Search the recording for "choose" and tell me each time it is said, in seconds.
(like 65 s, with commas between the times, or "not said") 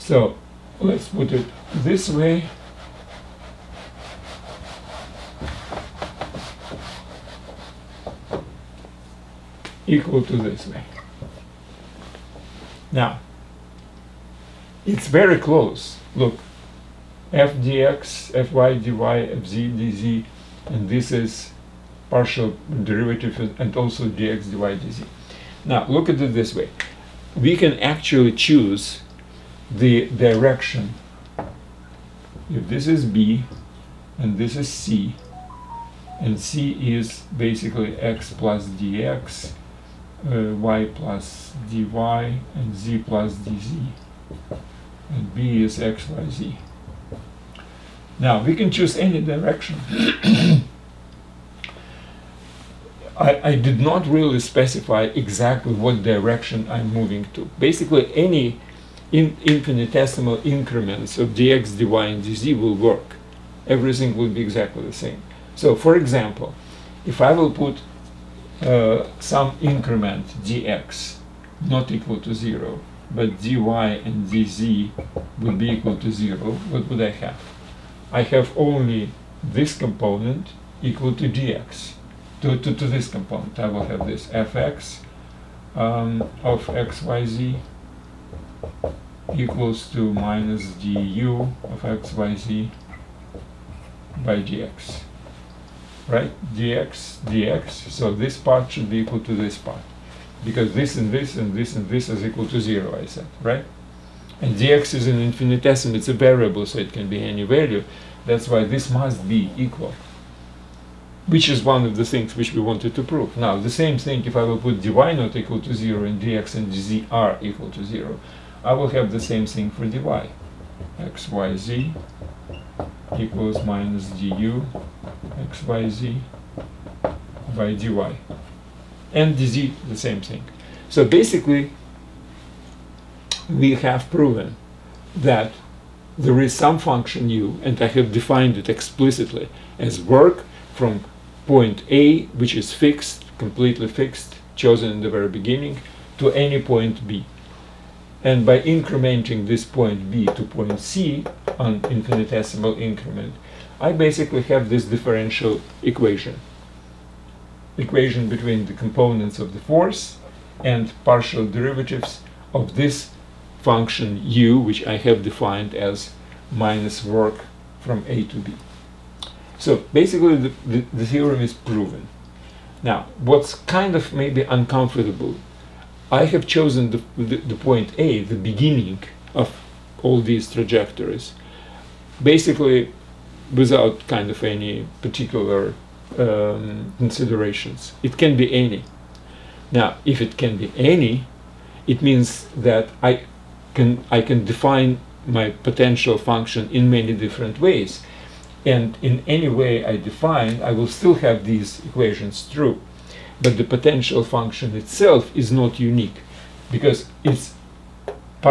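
28 s, 48 s.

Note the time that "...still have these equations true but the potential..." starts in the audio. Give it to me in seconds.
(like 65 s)
200 s.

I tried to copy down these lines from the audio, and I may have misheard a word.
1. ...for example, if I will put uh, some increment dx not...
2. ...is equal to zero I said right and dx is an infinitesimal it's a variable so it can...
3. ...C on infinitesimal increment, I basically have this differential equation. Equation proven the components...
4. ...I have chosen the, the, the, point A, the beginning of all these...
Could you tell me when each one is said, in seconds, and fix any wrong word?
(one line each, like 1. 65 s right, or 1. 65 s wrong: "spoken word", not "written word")
1. 65 s right
2. 102 s right
3. 150 s wrong: "between", not "proven"
4. 176 s right.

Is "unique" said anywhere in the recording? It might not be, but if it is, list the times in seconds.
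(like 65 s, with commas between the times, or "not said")
205 s.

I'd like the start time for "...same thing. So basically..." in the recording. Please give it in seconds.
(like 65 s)
129 s.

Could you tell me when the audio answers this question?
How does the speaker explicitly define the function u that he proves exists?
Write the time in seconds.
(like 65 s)
166 s.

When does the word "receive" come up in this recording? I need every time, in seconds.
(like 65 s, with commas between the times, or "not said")
not said.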